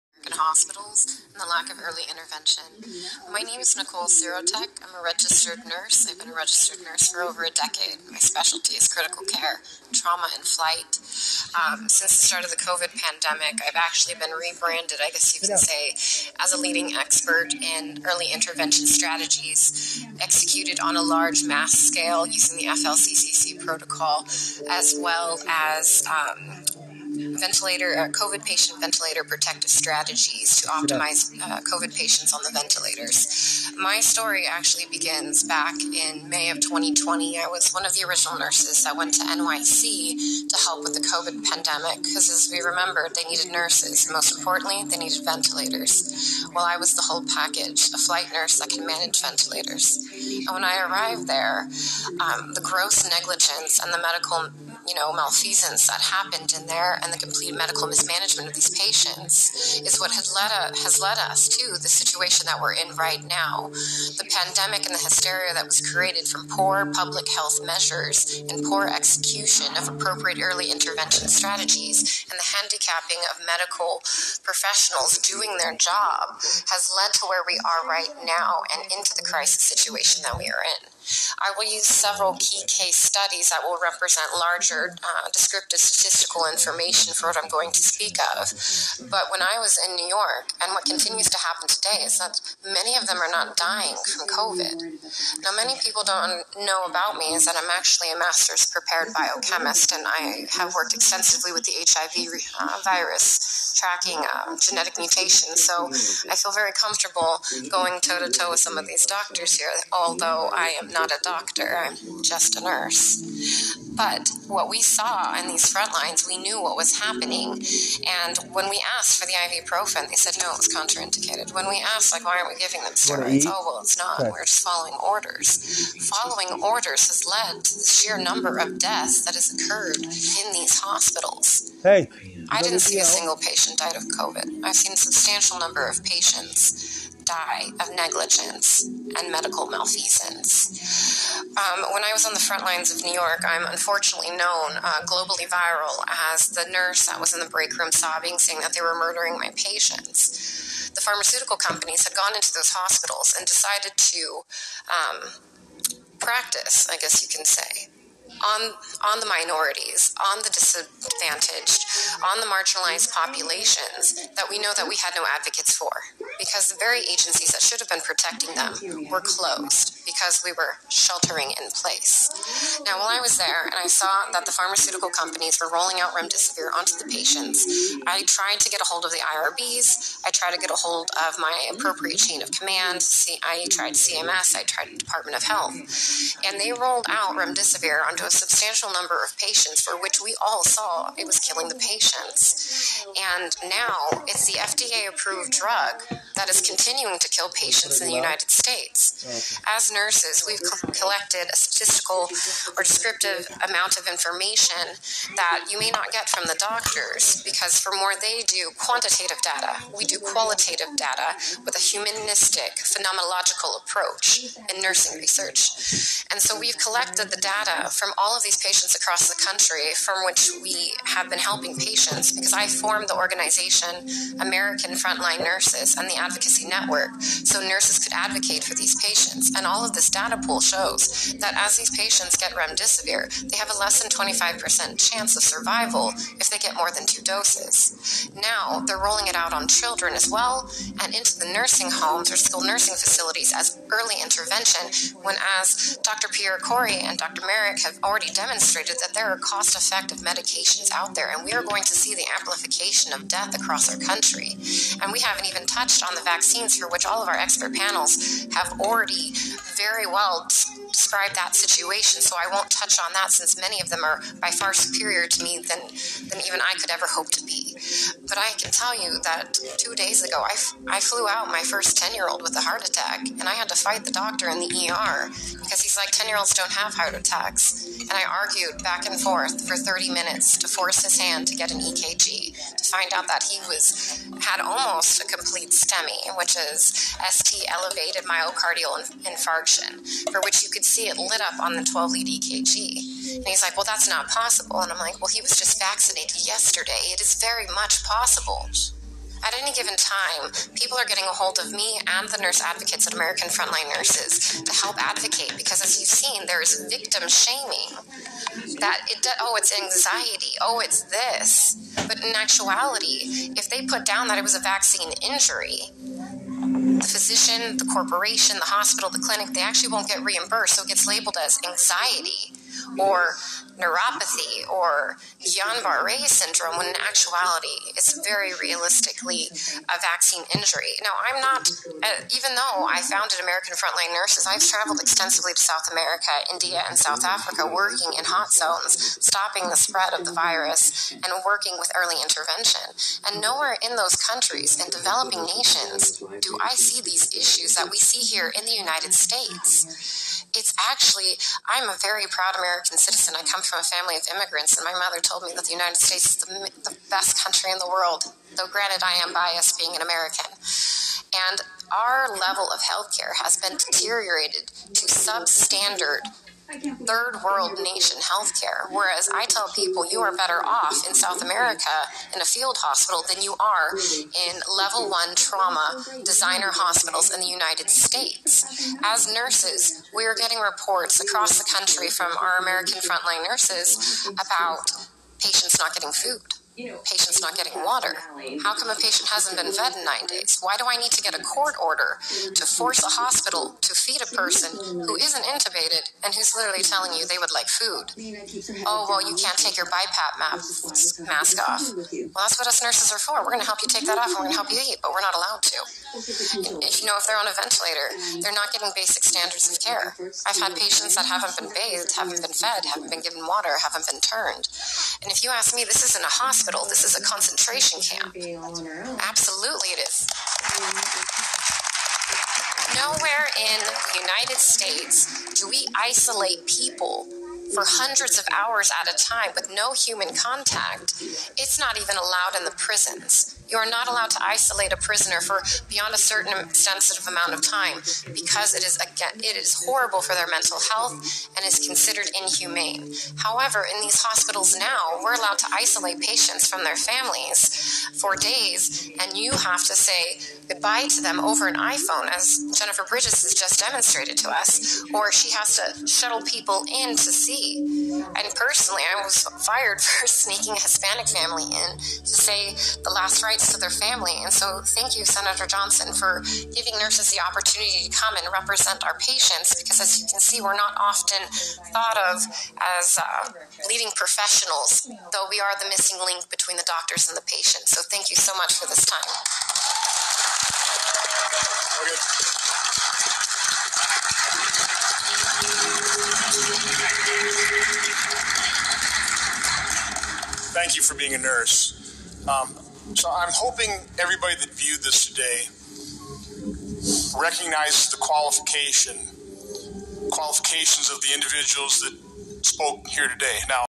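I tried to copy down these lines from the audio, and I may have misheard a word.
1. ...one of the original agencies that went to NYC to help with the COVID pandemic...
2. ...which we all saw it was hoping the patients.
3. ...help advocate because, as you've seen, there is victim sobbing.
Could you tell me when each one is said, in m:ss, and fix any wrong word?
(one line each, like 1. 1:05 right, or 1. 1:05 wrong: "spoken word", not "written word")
1. 0:37 wrong: "nurses", not "agencies"
2. 3:10 wrong: "killing", not "hoping"
3. 5:04 wrong: "shaming", not "sobbing".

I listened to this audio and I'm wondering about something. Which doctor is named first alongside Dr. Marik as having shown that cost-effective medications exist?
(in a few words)
Pierre Kory.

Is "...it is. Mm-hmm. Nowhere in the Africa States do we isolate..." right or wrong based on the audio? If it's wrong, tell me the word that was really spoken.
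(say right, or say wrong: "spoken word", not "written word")
wrong: "United", not "Africa".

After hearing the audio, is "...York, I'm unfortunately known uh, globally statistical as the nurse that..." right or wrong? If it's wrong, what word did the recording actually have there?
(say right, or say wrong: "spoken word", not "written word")
wrong: "viral", not "statistical".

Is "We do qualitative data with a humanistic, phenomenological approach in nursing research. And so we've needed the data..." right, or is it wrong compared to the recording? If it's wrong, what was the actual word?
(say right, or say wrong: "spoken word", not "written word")
wrong: "collected", not "needed".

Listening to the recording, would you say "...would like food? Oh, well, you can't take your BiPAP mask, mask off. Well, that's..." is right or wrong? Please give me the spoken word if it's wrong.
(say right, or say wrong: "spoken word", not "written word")
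right.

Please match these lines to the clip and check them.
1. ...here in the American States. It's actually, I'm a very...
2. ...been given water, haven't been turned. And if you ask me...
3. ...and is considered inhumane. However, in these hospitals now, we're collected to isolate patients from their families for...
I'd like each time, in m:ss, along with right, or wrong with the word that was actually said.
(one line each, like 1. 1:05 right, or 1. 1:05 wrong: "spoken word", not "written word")
1. 5:48 wrong: "United", not "American"
2. 6:53 right
3. 7:21 wrong: "allowed", not "collected".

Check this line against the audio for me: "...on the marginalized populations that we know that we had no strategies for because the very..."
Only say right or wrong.
wrong.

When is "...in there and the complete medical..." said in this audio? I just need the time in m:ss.
0:56.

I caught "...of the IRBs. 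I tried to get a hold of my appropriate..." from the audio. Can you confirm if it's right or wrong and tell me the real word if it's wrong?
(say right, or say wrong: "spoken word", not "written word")
right.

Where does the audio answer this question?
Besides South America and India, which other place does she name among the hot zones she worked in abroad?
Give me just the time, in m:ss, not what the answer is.
5:36.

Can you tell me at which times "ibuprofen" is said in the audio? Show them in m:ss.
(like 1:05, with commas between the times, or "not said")
1:59.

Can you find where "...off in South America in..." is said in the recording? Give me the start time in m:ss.
6:10.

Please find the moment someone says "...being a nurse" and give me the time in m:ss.
8:11.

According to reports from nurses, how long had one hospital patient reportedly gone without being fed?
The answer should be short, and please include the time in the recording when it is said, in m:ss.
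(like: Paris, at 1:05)
9 days, at 6:30.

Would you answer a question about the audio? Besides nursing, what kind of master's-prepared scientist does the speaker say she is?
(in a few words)
biochemist.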